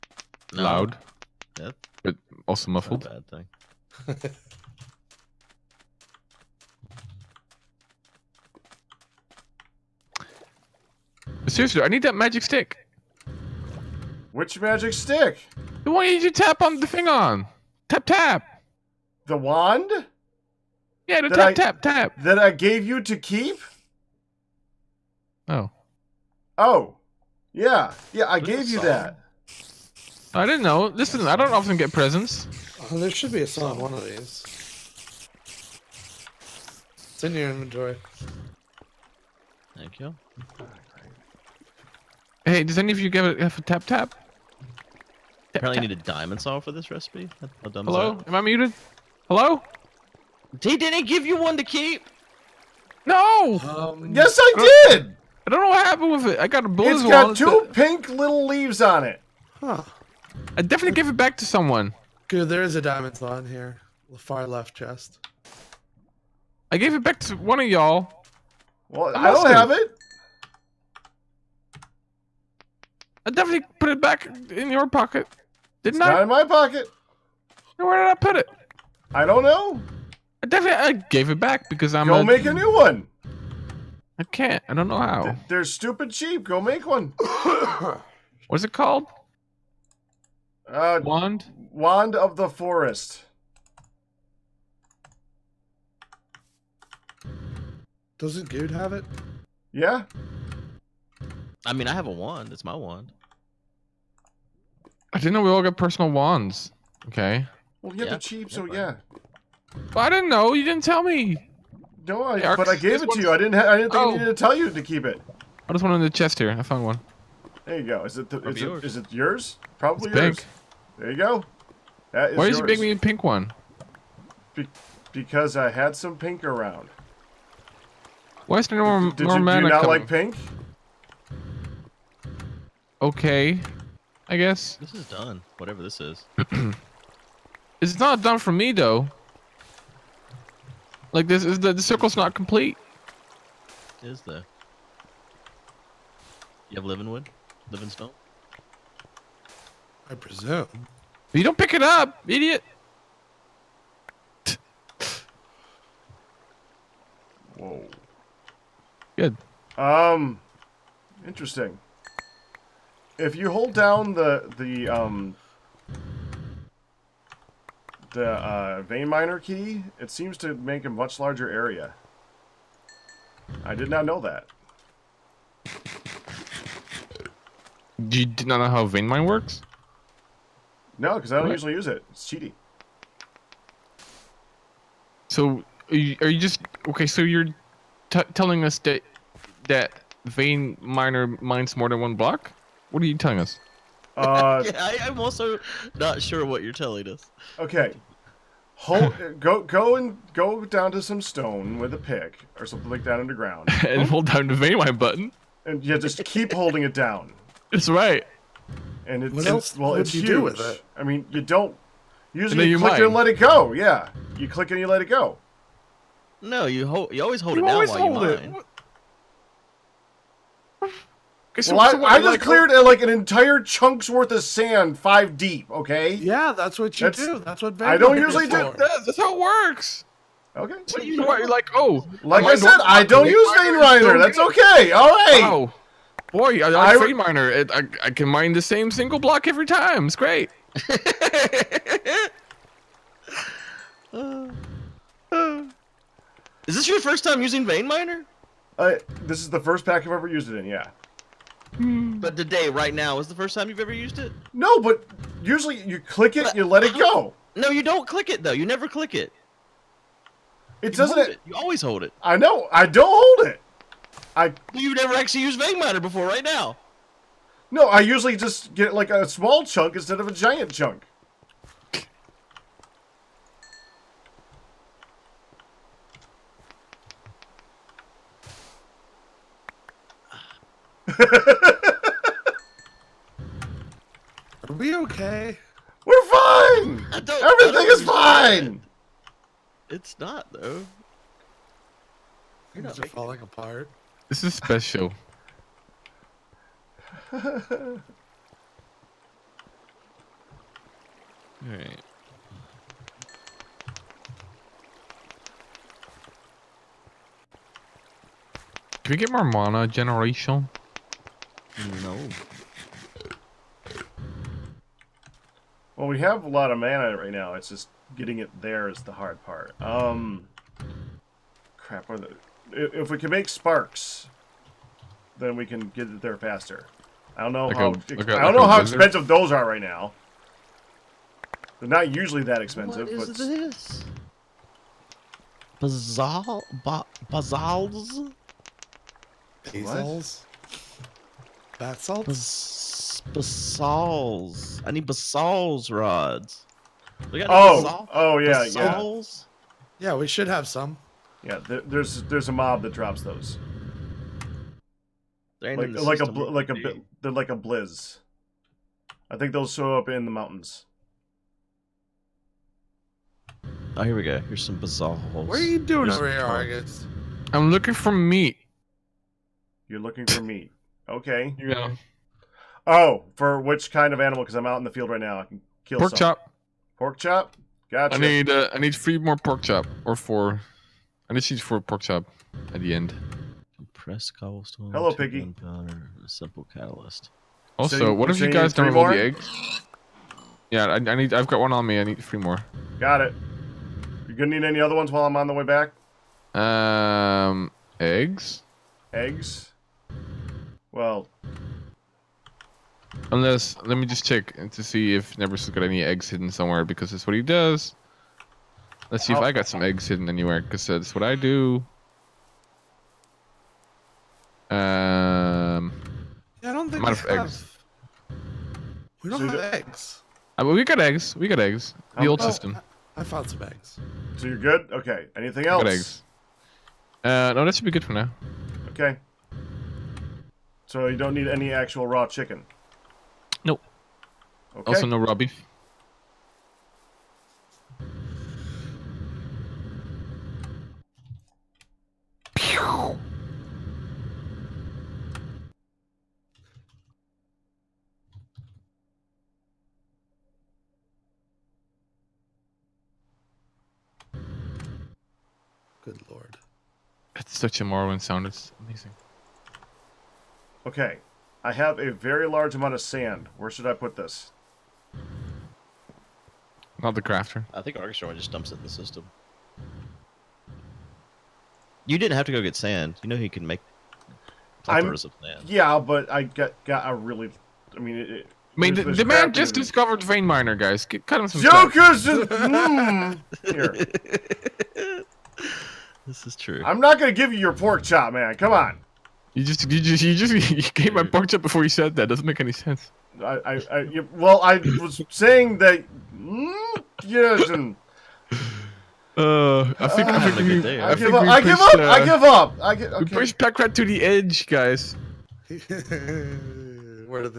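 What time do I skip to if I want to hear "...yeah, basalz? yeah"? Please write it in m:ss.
5:48.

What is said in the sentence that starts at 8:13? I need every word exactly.
I, I, I well, I was saying that.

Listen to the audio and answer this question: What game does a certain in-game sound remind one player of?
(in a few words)
Morrowind.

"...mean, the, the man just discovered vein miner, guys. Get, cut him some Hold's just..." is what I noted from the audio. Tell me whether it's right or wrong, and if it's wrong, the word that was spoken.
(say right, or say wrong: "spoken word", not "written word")
wrong: "Joker", not "Hold".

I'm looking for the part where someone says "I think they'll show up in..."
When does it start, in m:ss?
5:59.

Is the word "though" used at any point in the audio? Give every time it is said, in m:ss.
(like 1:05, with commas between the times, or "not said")
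2:18, 4:18, 4:50.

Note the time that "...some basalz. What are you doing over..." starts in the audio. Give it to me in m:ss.
6:04.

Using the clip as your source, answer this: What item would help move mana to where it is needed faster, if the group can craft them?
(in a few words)
Sparks.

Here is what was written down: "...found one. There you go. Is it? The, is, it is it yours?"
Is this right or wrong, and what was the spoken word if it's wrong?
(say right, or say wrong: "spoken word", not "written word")
right.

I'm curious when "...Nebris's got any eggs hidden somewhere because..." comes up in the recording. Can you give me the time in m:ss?
6:45.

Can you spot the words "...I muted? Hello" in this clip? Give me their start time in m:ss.
0:48.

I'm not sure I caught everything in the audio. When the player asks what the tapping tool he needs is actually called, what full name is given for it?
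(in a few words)
Wand of the forest.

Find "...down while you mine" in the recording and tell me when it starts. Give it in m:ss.
3:37.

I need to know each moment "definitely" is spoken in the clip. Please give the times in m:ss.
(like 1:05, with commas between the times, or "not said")
1:00, 1:13, 1:20.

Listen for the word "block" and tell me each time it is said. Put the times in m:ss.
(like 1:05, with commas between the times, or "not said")
3:12, 3:59.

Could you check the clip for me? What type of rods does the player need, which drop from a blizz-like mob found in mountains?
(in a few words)
Basalz rods.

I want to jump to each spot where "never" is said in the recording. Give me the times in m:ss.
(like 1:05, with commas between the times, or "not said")
4:18, 4:24.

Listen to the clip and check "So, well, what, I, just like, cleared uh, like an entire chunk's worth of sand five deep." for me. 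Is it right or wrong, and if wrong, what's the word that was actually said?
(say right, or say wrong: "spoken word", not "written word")
right.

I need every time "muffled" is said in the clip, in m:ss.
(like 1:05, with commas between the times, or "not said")
0:02.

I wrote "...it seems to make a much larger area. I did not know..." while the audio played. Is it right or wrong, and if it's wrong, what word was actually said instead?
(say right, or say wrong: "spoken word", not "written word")
right.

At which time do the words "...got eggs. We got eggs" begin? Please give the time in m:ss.
7:00.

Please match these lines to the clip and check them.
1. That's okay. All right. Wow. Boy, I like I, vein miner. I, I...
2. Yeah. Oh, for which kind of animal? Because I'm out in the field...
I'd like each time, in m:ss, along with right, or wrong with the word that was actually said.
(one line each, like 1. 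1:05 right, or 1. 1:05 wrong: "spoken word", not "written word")
1. 3:54 right
2. 6:11 right.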